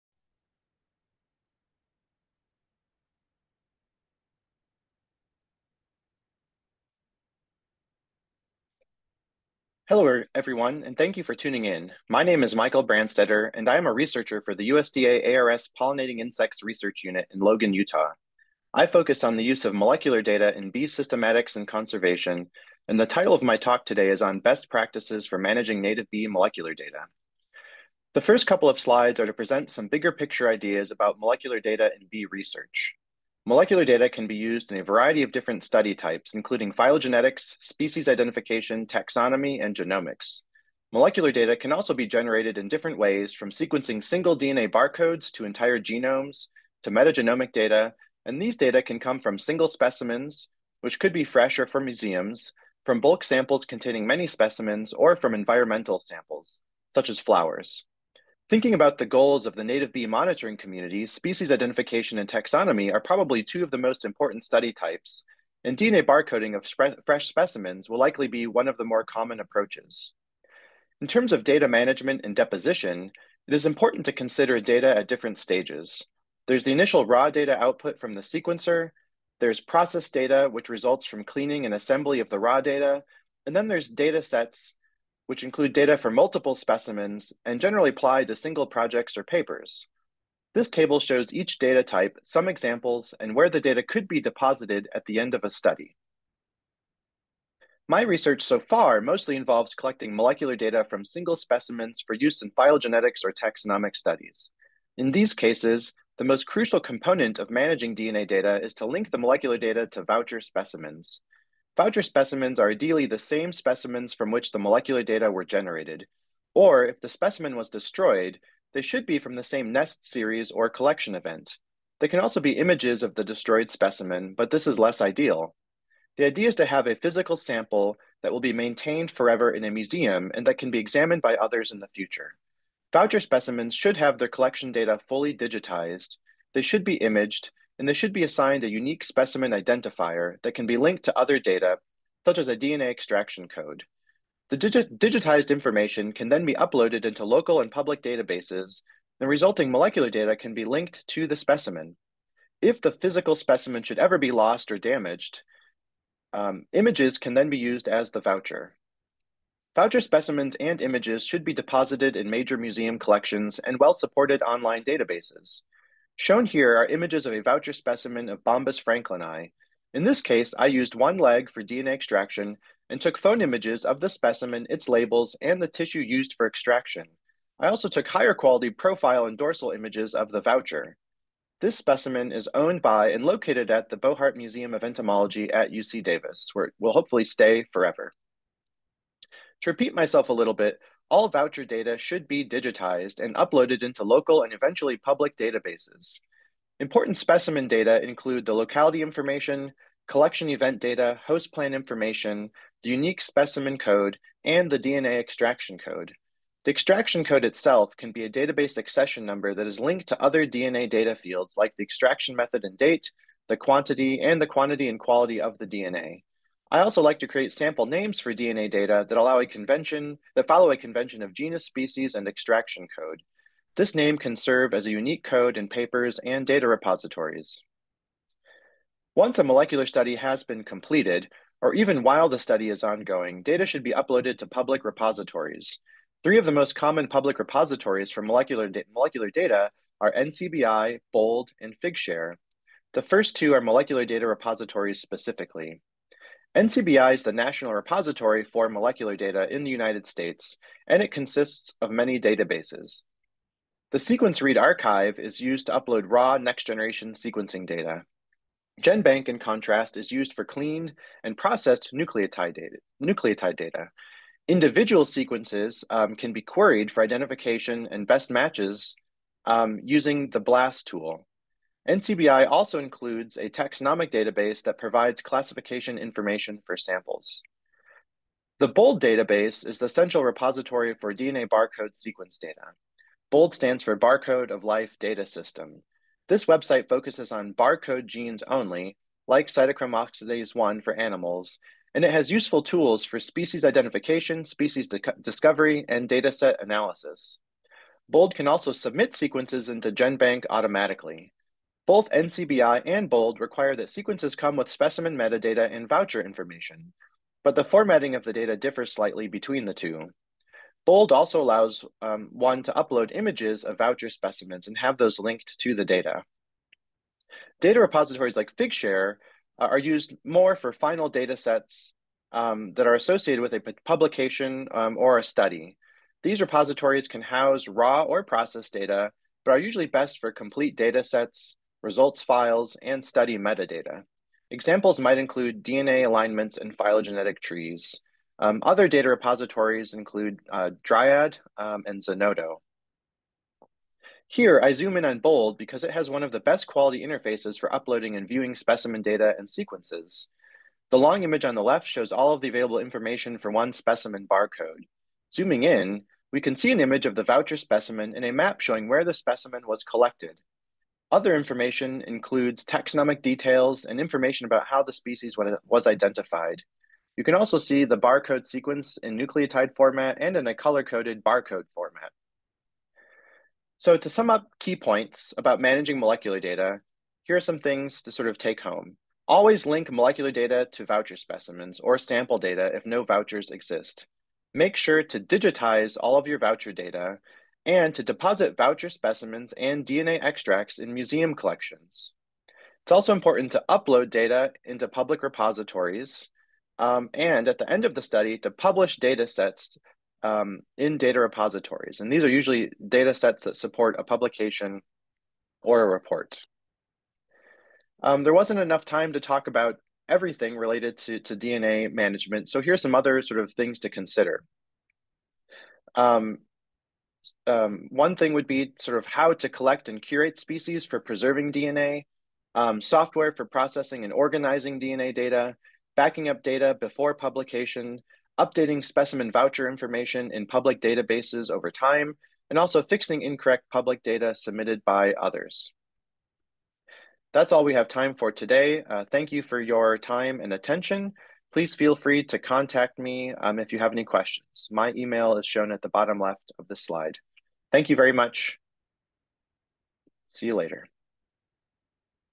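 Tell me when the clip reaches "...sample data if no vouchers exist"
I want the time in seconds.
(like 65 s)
381 s.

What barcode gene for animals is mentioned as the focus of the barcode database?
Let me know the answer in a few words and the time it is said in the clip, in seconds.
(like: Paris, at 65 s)
cytochrome oxidase 1, at 289 s.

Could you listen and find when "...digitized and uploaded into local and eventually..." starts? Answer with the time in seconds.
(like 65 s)
192 s.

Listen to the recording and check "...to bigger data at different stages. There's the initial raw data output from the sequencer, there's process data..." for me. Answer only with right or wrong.
wrong.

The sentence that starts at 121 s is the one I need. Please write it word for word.
They can also be images of the destroyed specimen, but this is less ideal.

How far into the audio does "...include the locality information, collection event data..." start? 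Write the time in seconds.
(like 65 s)
198 s.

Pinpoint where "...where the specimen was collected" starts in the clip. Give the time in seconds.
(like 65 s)
358 s.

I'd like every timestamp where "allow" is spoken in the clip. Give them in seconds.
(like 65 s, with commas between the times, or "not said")
219 s, 311 s.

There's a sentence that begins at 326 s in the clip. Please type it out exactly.
These repositories can house raw or processed data, but are usually best for complete data sets results files, and study metadata.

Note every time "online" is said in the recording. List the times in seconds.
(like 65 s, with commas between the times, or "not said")
164 s.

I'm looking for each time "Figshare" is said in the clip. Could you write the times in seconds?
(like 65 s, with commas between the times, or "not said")
241 s, 318 s.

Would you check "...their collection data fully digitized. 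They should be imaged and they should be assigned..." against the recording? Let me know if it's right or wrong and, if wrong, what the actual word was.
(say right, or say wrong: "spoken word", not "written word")
right.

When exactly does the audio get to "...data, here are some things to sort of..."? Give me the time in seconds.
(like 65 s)
376 s.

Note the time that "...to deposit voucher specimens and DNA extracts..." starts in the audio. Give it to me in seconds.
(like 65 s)
387 s.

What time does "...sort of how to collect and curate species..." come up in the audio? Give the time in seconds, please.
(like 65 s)
418 s.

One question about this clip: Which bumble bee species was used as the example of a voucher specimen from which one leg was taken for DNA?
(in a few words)
Bombus franklini.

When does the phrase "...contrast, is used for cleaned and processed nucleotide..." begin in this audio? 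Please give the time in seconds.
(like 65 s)
259 s.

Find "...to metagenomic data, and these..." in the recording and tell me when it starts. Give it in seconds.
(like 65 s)
46 s.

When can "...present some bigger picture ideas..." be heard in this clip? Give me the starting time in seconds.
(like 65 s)
29 s.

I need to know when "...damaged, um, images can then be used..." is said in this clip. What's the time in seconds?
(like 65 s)
154 s.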